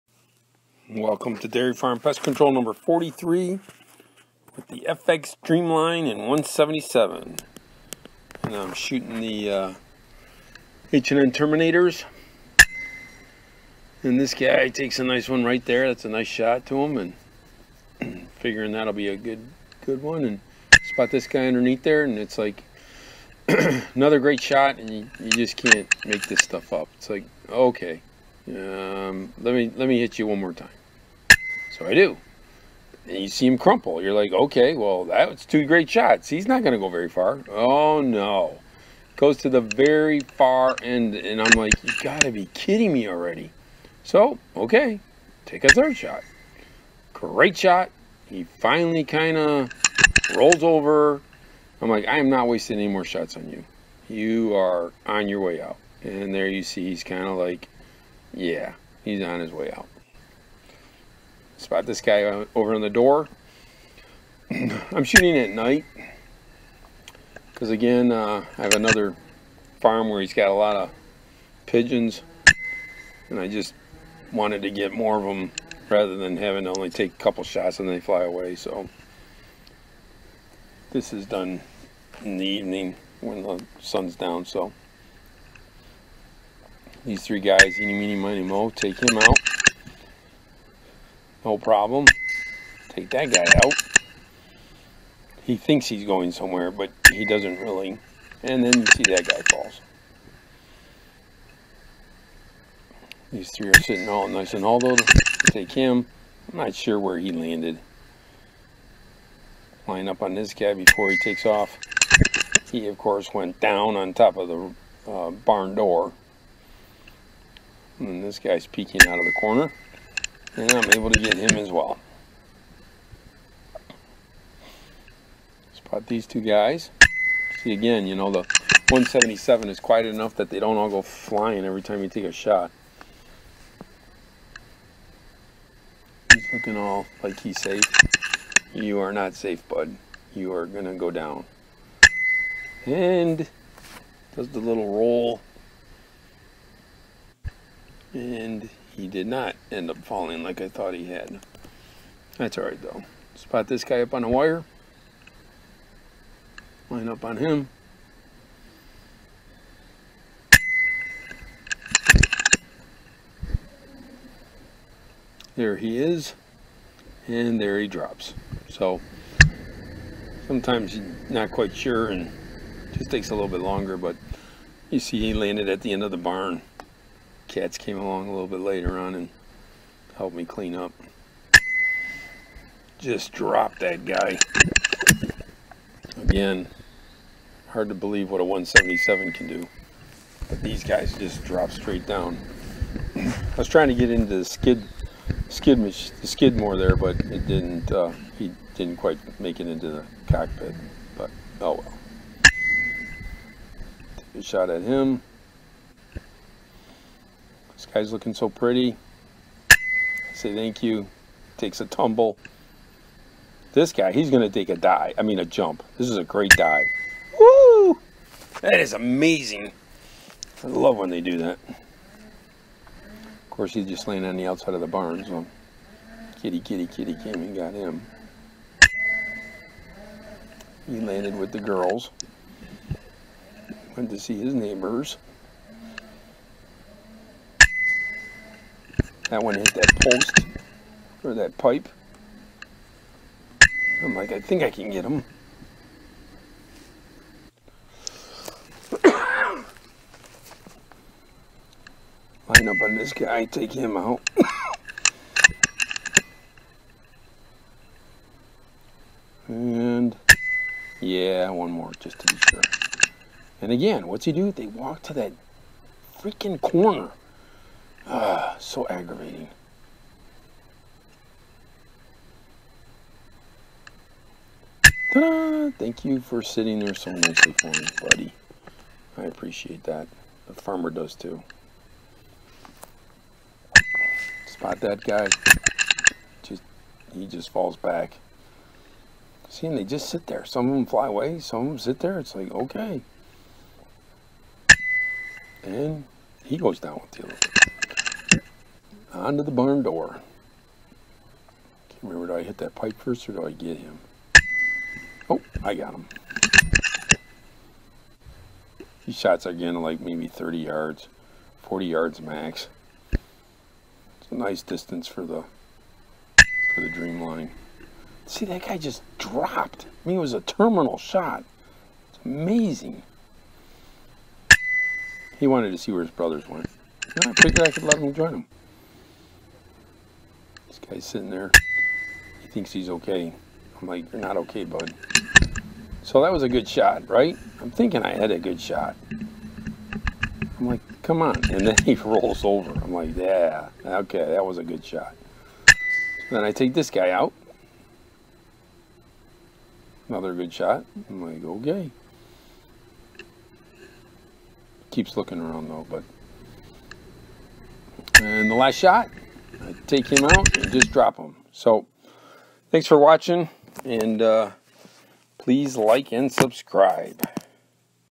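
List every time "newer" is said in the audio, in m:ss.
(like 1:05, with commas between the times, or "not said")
not said.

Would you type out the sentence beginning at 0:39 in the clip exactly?
Goes to the very far end, and I'm like, you got to be kidding me already.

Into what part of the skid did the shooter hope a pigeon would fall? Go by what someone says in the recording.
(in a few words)
the cockpit.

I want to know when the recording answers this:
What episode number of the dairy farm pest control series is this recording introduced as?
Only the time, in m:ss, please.
0:02.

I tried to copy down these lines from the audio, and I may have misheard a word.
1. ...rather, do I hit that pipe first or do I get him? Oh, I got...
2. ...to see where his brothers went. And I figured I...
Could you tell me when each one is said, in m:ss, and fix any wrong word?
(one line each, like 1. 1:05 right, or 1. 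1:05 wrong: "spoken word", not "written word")
1. 5:02 wrong: "remember", not "rather"
2. 5:25 right.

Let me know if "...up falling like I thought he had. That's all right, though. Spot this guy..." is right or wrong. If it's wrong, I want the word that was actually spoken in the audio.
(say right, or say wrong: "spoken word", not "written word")
right.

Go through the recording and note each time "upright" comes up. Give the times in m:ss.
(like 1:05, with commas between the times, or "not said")
not said.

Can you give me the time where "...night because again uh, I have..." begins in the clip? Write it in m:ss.
1:05.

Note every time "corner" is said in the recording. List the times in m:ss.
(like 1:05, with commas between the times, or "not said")
1:59, 4:26.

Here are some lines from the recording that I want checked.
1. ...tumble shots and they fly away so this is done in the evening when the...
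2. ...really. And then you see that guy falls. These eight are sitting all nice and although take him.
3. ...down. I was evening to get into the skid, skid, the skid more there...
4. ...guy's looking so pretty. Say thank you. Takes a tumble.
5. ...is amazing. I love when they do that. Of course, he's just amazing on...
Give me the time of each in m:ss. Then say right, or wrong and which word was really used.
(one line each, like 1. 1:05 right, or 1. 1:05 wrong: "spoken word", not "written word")
1. 1:17 wrong: "couple", not "tumble"
2. 1:37 wrong: "three", not "eight"
3. 3:12 wrong: "trying", not "evening"
4. 3:27 right
5. 3:38 wrong: "laying", not "amazing".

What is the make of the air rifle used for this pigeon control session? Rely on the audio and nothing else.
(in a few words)
FX Streamline.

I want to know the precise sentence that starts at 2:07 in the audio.
See again, you know, the 177 is quiet enough that they don't all go flying every time you take a shot.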